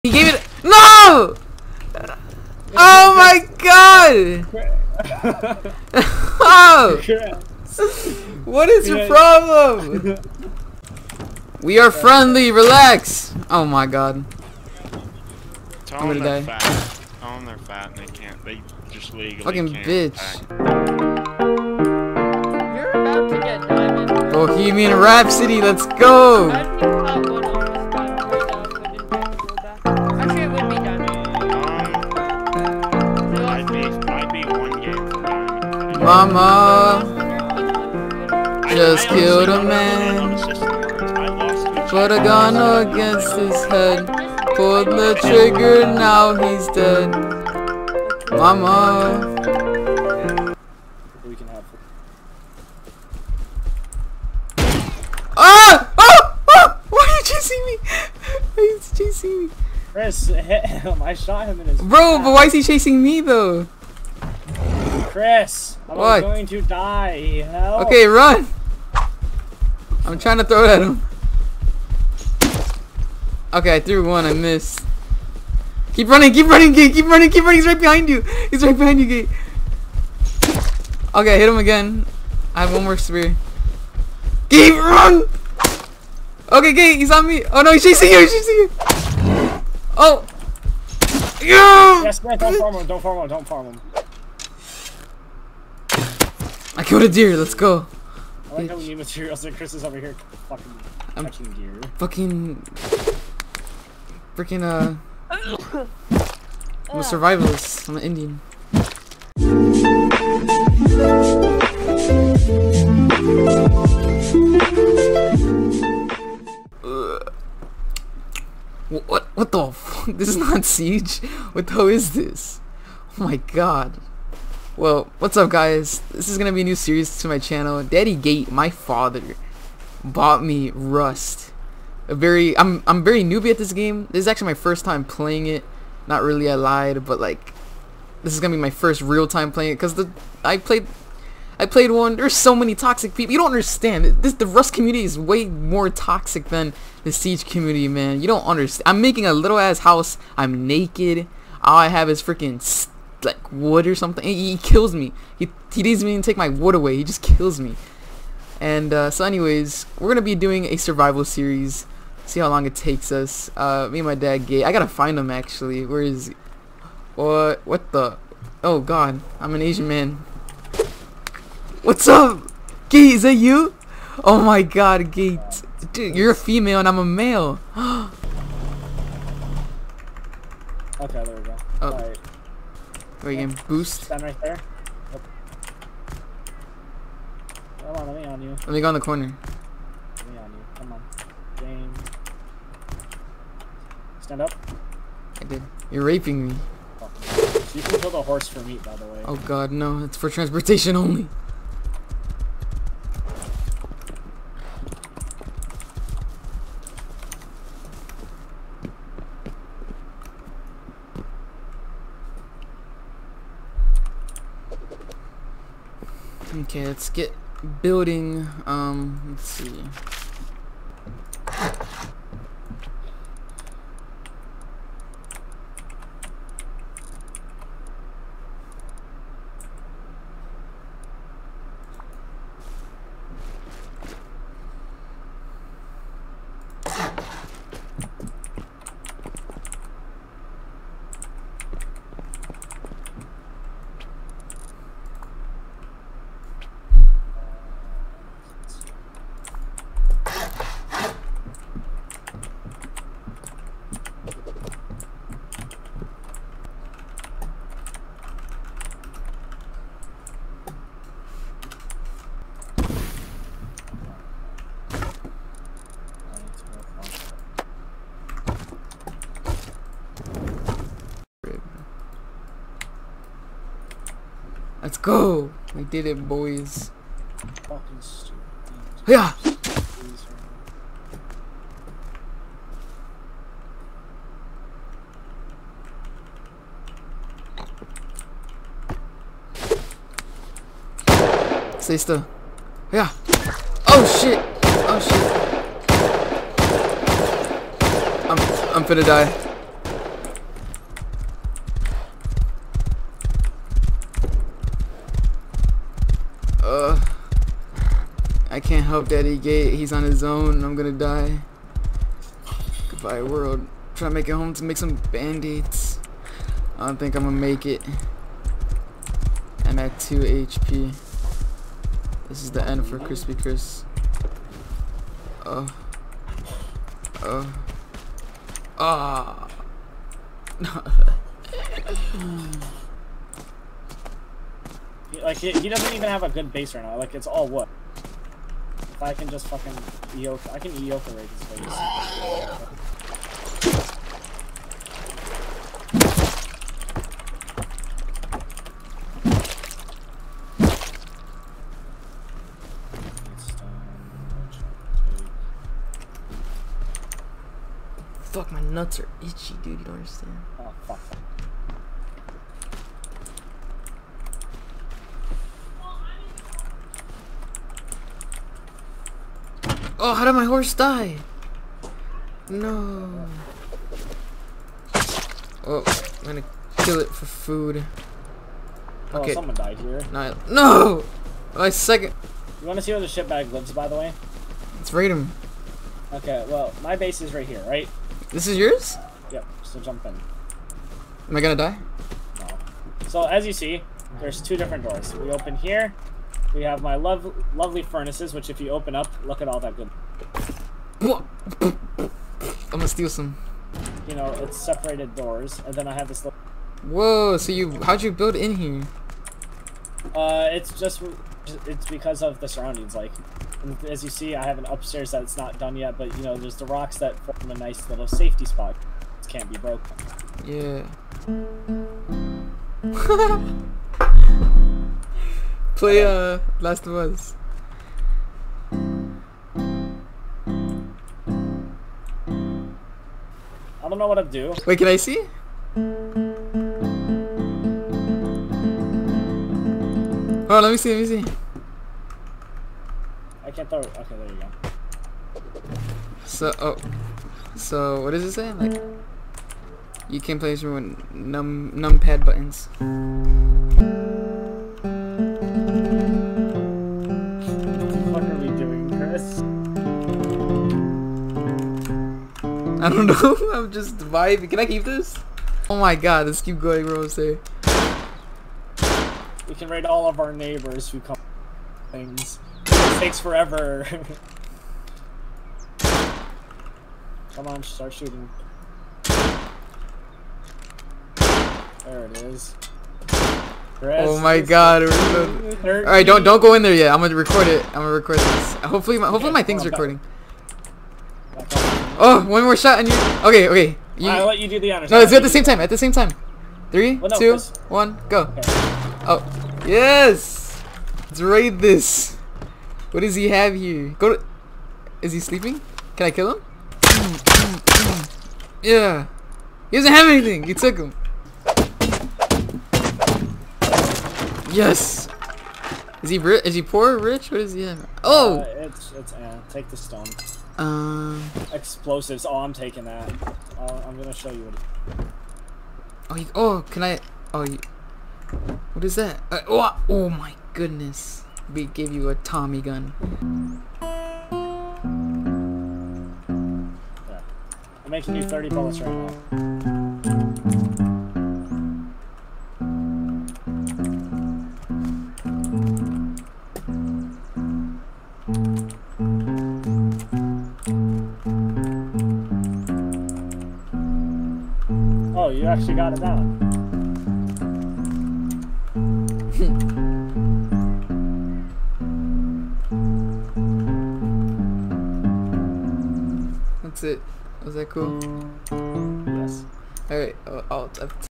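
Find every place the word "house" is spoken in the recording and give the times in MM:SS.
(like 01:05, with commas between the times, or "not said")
02:29.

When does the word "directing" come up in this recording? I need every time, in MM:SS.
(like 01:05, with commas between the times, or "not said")
not said.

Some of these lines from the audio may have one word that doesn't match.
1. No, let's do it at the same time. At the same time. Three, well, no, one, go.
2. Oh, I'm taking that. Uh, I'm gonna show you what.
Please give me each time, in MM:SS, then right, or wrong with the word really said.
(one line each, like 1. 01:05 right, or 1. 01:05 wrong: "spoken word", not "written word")
1. 08:14 right
2. 08:42 right.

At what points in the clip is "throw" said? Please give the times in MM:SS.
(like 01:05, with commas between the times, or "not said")
01:10, 07:23.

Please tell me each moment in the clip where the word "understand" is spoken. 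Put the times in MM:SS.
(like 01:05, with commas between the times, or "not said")
02:23, 02:28, 05:59.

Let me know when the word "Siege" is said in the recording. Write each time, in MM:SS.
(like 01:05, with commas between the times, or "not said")
02:00, 02:27.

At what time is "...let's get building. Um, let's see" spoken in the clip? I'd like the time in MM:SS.
03:36.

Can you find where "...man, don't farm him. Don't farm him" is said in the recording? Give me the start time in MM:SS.
01:32.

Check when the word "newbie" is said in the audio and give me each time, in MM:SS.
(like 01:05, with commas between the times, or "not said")
02:13.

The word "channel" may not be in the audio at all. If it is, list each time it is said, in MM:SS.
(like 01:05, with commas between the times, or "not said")
02:07.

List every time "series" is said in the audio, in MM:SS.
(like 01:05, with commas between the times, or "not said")
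02:06, 02:41.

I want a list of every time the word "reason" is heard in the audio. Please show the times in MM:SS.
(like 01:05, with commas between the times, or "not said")
not said.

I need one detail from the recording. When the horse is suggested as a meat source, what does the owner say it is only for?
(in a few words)
transportation.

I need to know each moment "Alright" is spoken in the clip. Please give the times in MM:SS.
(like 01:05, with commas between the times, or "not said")
08:05, 09:29.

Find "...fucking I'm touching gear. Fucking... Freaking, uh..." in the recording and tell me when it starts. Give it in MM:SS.
01:40.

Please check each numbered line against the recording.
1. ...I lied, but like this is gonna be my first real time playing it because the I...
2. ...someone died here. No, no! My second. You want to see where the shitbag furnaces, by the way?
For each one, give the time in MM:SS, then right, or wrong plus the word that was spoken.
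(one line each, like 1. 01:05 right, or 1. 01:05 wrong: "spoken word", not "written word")
1. 02:16 right
2. 06:19 wrong: "lives", not "furnaces".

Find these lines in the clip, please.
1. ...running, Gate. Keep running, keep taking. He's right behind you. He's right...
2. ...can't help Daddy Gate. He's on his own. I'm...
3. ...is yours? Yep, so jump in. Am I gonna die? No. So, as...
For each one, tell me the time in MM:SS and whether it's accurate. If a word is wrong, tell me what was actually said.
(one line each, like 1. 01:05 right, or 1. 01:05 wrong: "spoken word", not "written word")
1. 01:16 wrong: "running", not "taking"
2. 05:08 right
3. 06:28 right.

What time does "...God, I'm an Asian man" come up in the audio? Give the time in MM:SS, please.
02:48.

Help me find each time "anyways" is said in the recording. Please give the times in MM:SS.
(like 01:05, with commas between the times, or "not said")
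02:39.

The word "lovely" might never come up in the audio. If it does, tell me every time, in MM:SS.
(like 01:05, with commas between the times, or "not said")
06:37.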